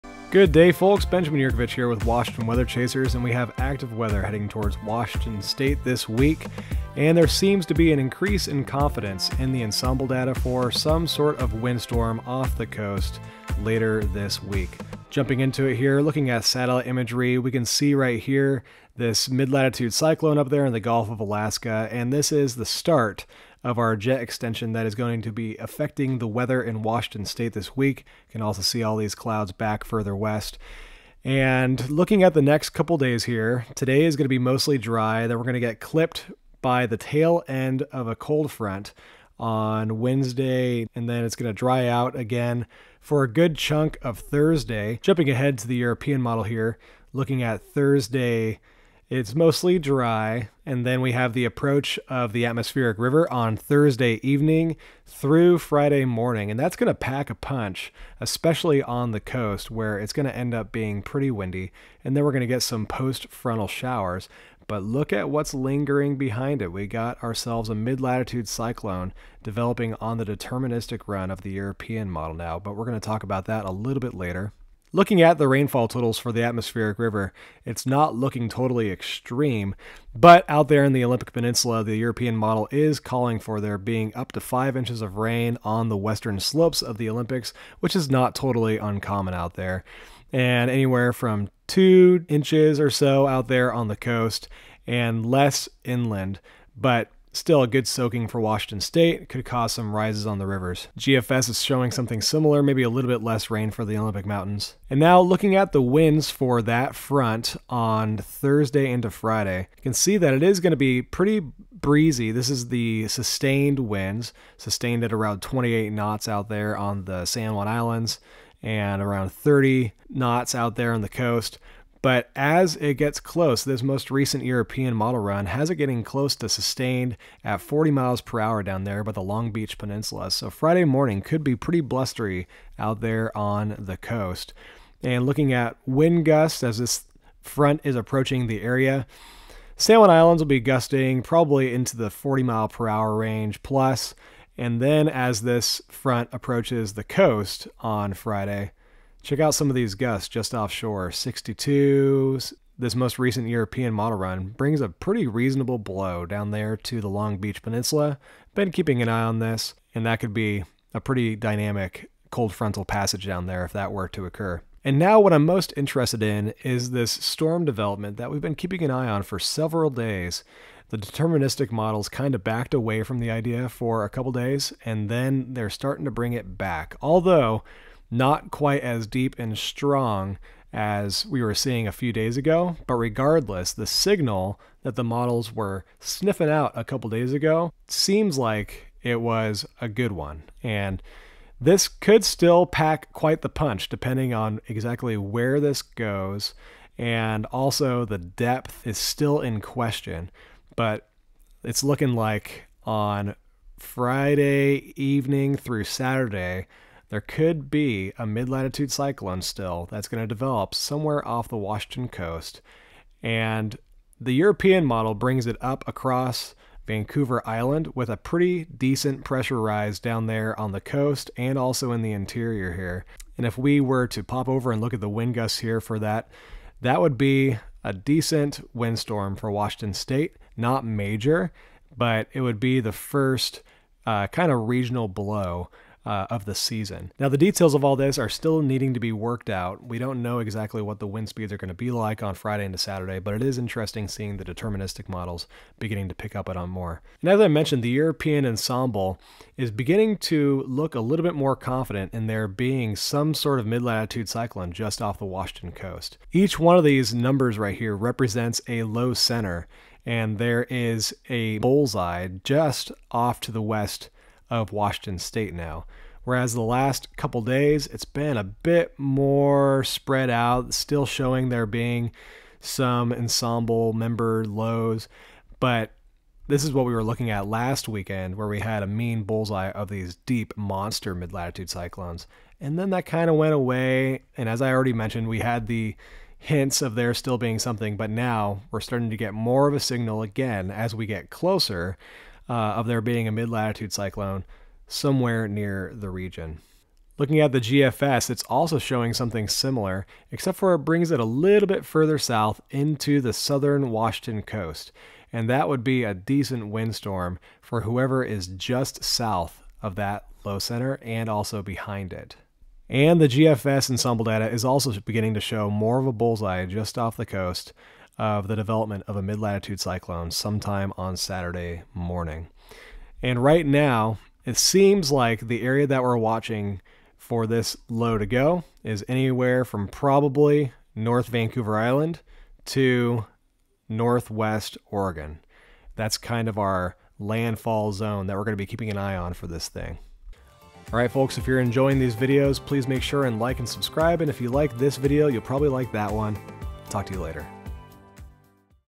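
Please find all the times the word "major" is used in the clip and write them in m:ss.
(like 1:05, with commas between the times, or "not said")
3:50.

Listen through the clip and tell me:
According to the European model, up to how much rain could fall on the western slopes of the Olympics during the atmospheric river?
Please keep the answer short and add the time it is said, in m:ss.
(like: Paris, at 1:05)
5 inches, at 1:24.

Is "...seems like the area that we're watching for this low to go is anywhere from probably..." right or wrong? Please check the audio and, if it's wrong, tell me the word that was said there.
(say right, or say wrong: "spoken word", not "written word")
right.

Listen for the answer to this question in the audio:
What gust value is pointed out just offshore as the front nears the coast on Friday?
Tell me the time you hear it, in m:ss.
2:31.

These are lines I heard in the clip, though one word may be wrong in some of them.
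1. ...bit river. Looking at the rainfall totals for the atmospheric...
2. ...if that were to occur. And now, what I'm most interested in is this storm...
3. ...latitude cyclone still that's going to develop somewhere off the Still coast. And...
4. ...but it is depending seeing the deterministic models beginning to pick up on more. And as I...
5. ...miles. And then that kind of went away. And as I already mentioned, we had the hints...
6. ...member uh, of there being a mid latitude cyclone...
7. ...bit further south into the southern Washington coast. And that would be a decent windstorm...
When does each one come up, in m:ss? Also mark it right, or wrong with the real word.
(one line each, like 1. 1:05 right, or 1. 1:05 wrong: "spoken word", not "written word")
1. 1:14 wrong: "later", not "river"
2. 2:43 right
3. 3:28 wrong: "Washington", not "Still"
4. 4:03 wrong: "interesting", not "depending"
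5. 4:41 wrong: "cyclones", not "miles"
6. 4:51 wrong: "closer", not "member"
7. 5:01 right.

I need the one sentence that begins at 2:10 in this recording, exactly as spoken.
So Friday morning could be pretty blustery out there on the coast.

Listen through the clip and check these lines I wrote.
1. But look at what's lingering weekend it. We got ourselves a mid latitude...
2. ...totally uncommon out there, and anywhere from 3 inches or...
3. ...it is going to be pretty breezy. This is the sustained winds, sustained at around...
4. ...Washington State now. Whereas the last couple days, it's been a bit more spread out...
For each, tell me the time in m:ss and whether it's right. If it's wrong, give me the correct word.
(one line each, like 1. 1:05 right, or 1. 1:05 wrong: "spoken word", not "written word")
1. 1:04 wrong: "behind", not "weekend"
2. 1:28 wrong: "2", not "3"
3. 1:50 right
4. 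4:24 right.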